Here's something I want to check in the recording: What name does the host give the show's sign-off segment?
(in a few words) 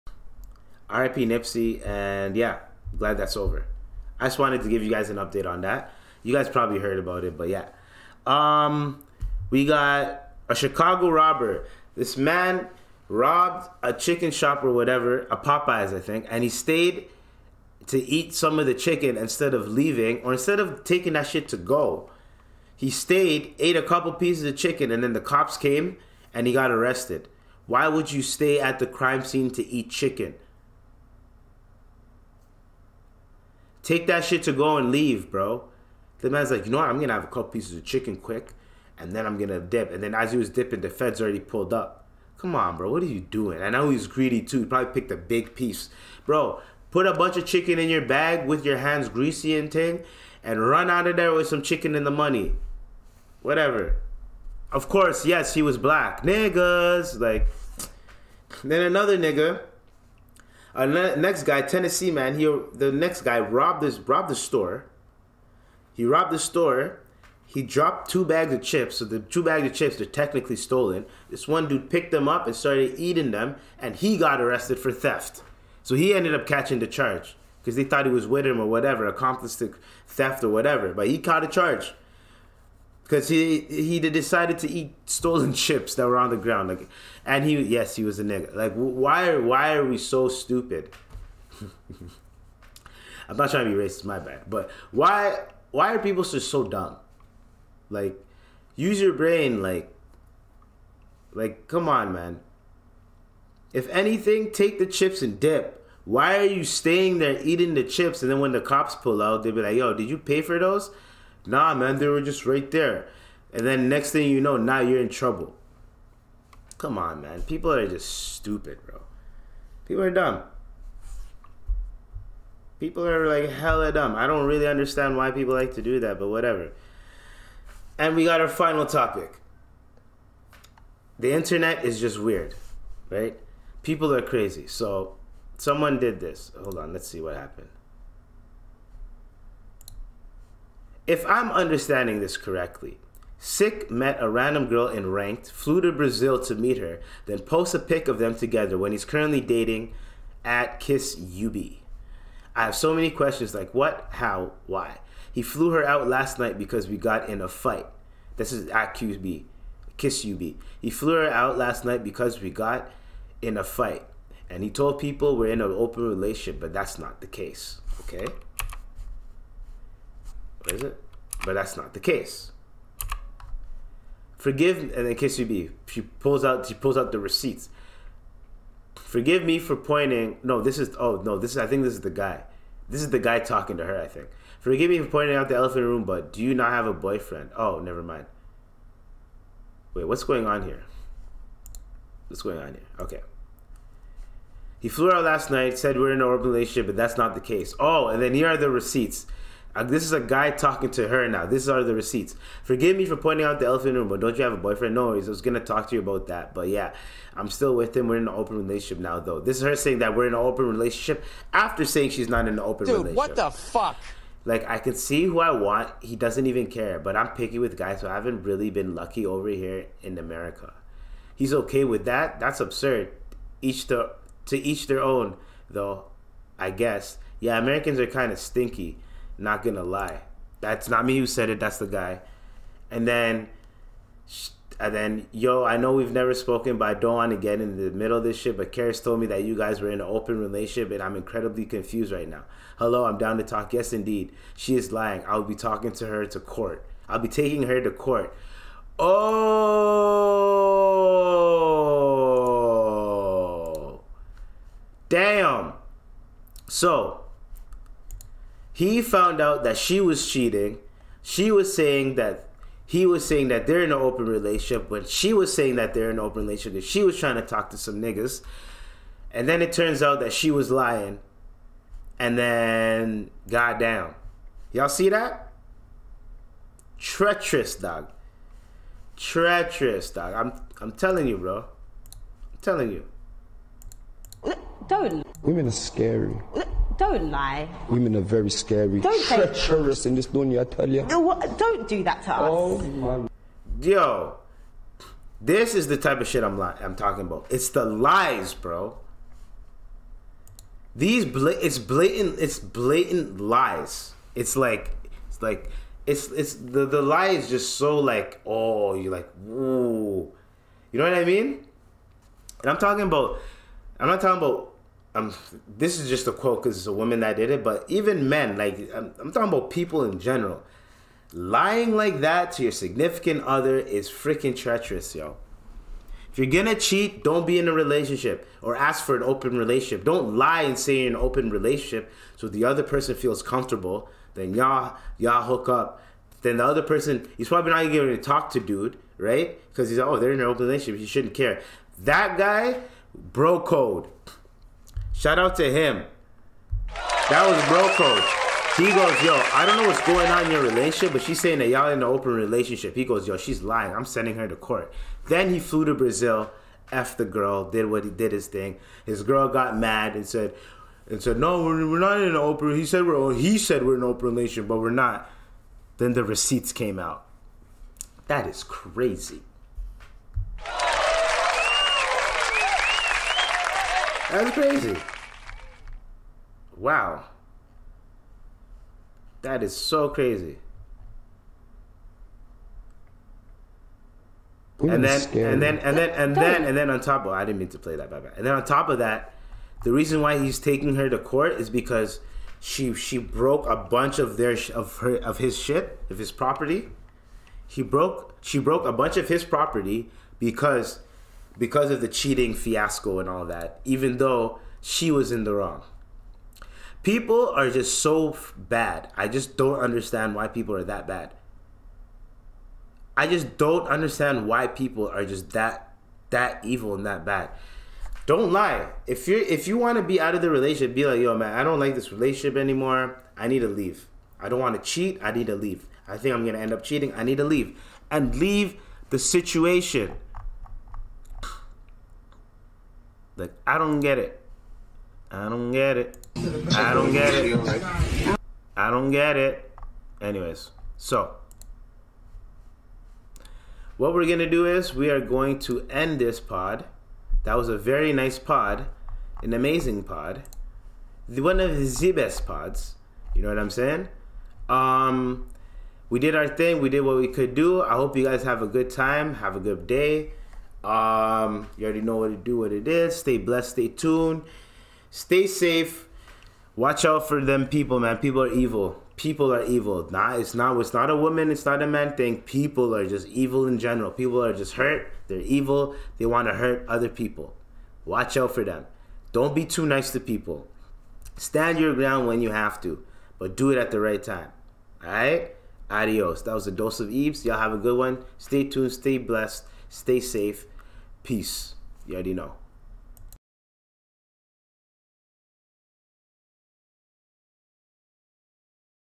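Ibz.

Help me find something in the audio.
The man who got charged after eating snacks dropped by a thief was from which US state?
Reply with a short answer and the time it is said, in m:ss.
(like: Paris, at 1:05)
Tennessee, at 1:01.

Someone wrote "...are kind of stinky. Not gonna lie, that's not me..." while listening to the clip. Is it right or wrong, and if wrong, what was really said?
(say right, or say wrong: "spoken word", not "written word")
right.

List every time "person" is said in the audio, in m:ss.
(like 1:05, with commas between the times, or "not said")
5:32, 5:36.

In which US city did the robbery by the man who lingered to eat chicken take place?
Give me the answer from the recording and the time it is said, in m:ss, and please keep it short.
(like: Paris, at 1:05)
Chicago, at 0:10.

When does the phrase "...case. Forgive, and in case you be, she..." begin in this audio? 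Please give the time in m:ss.
2:51.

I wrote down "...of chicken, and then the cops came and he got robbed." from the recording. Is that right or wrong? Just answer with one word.
wrong.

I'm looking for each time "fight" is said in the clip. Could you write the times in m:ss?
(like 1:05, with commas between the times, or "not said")
2:37, 2:43.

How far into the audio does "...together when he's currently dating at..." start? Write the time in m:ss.
2:28.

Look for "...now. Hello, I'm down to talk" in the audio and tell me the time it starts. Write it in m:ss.
4:02.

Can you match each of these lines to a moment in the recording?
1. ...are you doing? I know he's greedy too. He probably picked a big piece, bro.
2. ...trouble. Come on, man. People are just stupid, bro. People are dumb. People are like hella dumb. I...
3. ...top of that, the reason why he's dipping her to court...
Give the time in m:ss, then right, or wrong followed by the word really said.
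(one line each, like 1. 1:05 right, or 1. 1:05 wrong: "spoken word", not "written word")
1. 0:43 right
2. 1:55 right
3. 6:28 wrong: "taking", not "dipping".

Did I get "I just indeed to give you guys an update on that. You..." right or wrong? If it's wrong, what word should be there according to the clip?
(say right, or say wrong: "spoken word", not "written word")
wrong: "wanted", not "indeed".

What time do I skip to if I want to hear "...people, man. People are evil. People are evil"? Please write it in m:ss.
7:47.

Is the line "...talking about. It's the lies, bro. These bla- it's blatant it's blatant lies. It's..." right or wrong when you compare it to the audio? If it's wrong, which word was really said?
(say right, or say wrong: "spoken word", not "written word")
right.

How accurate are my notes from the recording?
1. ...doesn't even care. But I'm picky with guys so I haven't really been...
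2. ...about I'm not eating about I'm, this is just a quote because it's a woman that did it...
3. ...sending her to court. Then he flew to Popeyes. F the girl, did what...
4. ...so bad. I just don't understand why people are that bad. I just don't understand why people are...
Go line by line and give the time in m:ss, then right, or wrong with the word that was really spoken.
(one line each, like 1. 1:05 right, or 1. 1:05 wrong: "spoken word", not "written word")
1. 3:36 right
2. 5:13 wrong: "talking", not "eating"
3. 5:54 wrong: "Brazil", not "Popeyes"
4. 6:47 right.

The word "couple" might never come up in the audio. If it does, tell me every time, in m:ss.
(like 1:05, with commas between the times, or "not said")
0:23, 0:37.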